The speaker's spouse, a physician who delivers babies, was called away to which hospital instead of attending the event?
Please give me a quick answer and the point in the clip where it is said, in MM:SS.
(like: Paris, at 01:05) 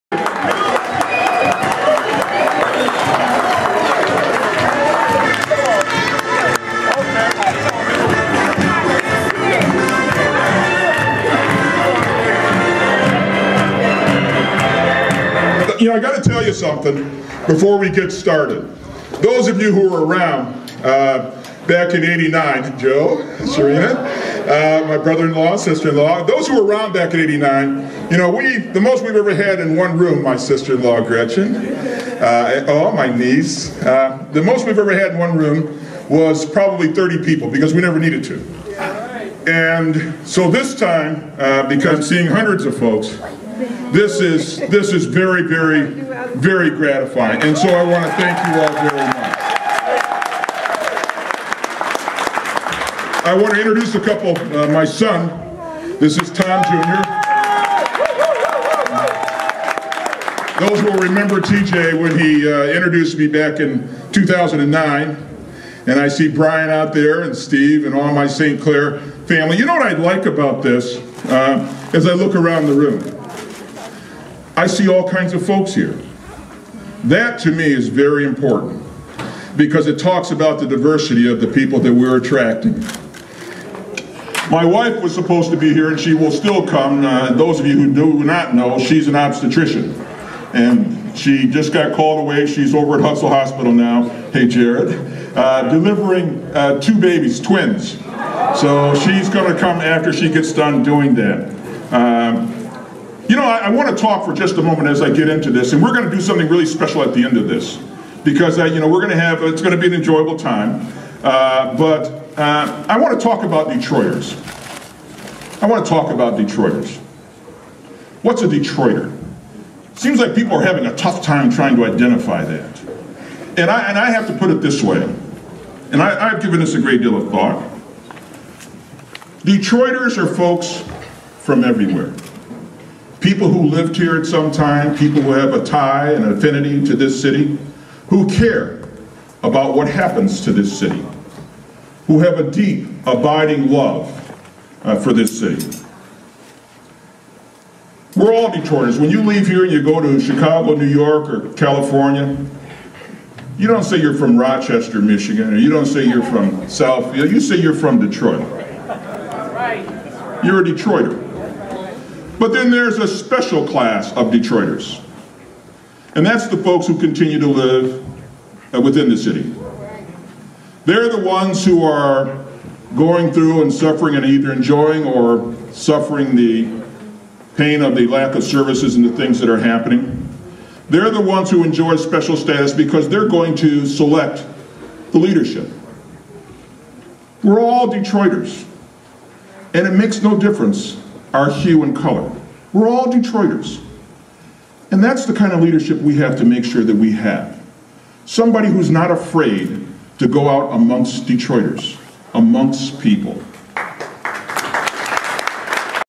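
Hutzel Hospital, at 01:33.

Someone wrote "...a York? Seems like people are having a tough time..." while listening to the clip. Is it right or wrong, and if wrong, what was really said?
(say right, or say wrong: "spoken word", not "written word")
wrong: "Detroiter", not "York".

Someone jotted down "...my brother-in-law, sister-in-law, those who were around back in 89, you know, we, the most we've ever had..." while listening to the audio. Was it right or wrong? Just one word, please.
right.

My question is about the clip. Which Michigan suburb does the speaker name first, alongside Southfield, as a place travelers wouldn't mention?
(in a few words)
Rochester, Michigan.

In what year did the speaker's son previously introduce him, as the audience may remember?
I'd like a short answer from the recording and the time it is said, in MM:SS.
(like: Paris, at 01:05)
2009, at 01:04.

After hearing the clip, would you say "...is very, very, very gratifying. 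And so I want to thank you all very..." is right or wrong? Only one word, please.
right.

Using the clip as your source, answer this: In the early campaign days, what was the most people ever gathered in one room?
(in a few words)
30.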